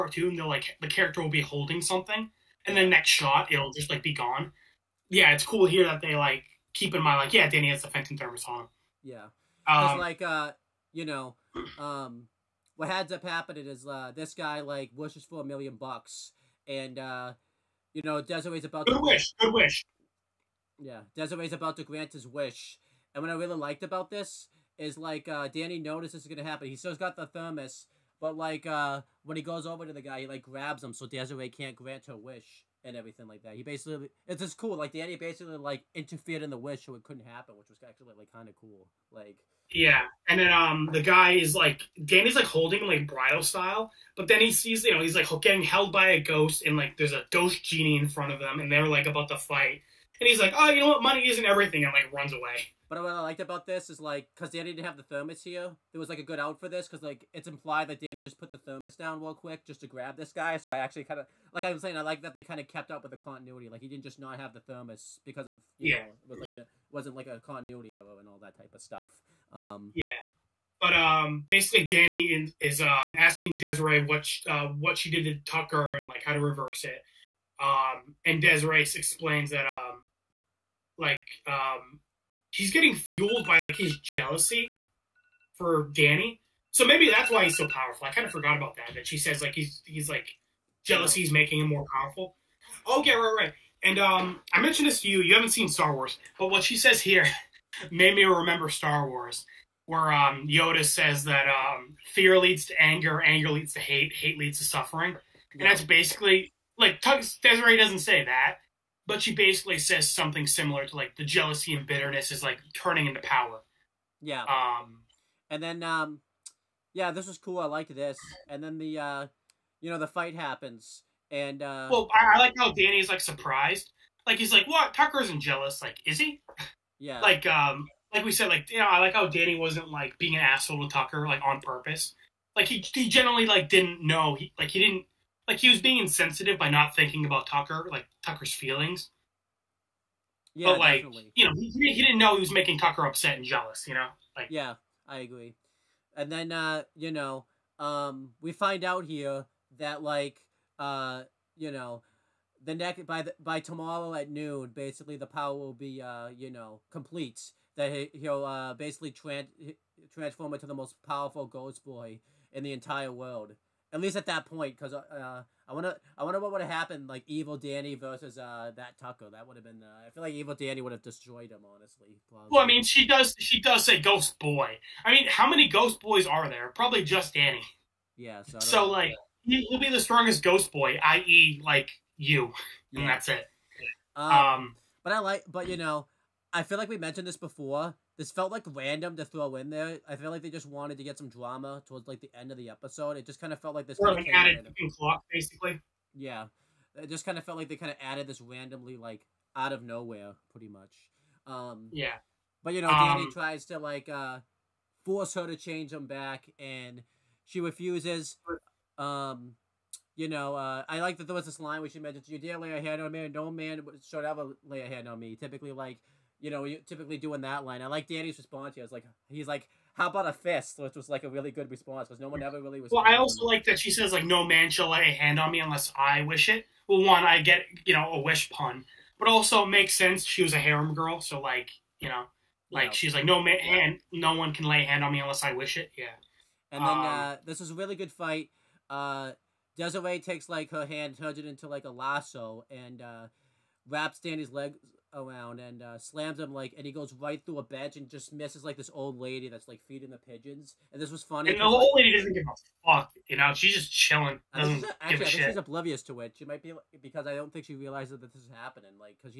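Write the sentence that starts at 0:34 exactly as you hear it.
Like Danny basically like interfered in the wish so it couldn't happen, which was actually like kind of cool.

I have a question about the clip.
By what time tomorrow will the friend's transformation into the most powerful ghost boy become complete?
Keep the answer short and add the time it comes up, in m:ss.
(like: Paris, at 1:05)
noon, at 2:34.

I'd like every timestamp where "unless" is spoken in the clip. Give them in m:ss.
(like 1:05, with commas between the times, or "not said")
3:45, 3:55.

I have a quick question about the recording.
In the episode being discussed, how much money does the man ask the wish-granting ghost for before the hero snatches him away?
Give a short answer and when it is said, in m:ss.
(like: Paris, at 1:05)
a million bucks, at 0:15.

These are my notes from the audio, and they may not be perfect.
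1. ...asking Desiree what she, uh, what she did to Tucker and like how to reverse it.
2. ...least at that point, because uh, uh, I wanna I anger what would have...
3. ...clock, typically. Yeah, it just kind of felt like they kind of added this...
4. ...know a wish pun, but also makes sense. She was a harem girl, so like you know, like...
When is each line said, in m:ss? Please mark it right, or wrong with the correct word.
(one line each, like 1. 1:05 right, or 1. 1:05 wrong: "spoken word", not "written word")
1. 1:13 right
2. 2:44 wrong: "wonder", not "anger"
3. 3:14 wrong: "basically", not "typically"
4. 3:47 right.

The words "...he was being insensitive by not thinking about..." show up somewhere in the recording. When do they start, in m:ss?
2:15.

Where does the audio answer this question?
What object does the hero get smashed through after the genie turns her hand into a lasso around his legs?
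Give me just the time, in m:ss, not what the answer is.
4:07.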